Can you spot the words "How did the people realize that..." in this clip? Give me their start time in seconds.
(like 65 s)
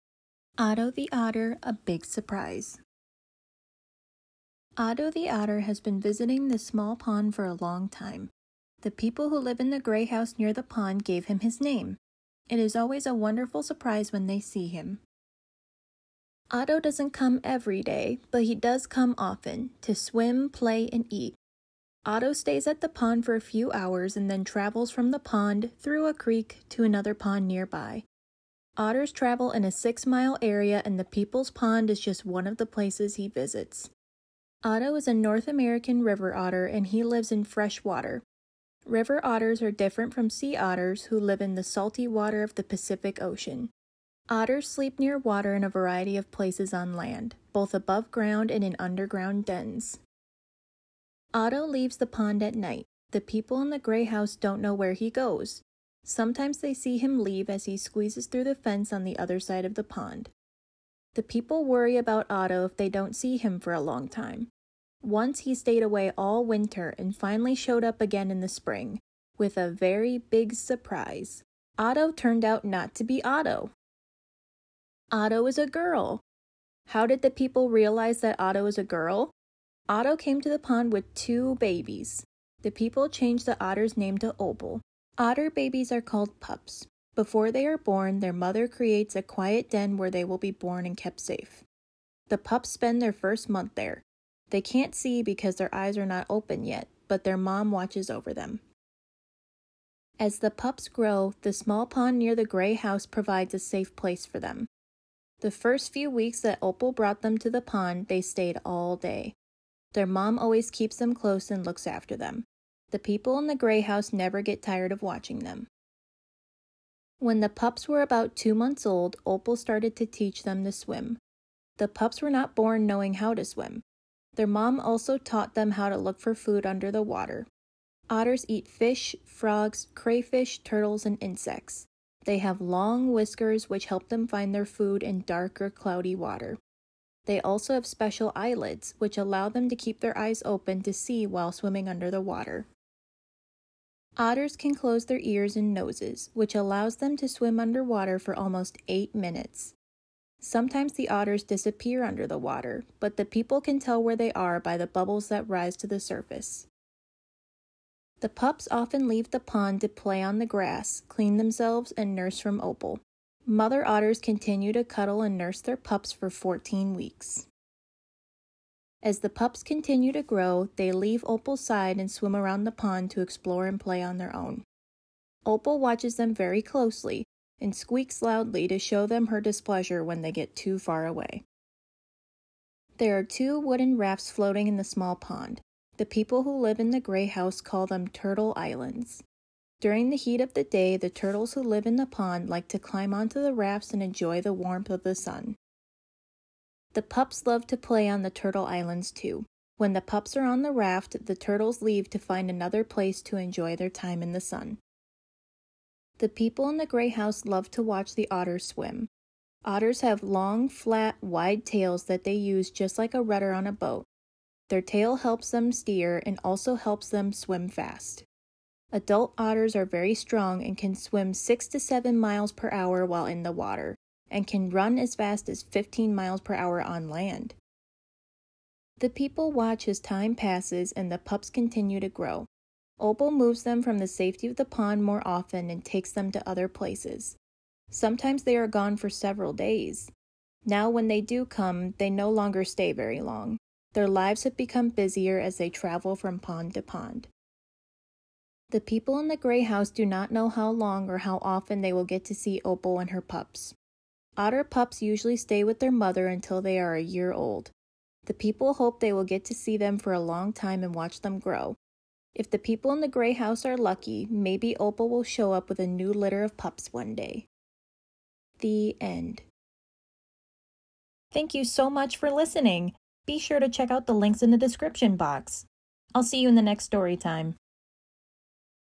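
76 s.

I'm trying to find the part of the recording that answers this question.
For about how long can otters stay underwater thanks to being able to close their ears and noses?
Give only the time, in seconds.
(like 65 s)
148 s.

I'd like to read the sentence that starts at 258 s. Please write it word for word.
The people hope they will get to see them for a long time and watch them grow.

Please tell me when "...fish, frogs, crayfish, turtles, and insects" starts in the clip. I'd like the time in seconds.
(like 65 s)
128 s.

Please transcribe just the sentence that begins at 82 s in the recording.
The people changed the otter's name to Opal.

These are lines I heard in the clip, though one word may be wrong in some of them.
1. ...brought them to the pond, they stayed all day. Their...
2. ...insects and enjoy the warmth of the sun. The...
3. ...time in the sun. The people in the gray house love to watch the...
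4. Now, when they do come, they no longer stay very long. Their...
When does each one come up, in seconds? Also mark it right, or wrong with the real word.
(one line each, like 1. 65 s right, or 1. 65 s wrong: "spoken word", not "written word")
1. 106 s right
2. 193 s wrong: "rafts", not "insects"
3. 203 s right
4. 240 s right.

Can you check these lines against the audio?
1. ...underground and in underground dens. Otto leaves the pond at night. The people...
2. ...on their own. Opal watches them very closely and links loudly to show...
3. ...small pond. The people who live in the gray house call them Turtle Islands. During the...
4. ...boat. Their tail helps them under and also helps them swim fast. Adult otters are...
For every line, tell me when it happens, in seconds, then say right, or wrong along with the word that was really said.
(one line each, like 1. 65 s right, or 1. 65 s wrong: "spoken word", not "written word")
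1. 48 s wrong: "ground", not "underground"
2. 174 s wrong: "squeaks", not "links"
3. 184 s right
4. 213 s wrong: "steer", not "under".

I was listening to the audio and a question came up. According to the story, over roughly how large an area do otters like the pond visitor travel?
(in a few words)
6 miles.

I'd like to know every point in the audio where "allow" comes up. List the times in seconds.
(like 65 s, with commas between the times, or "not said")
139 s, 146 s.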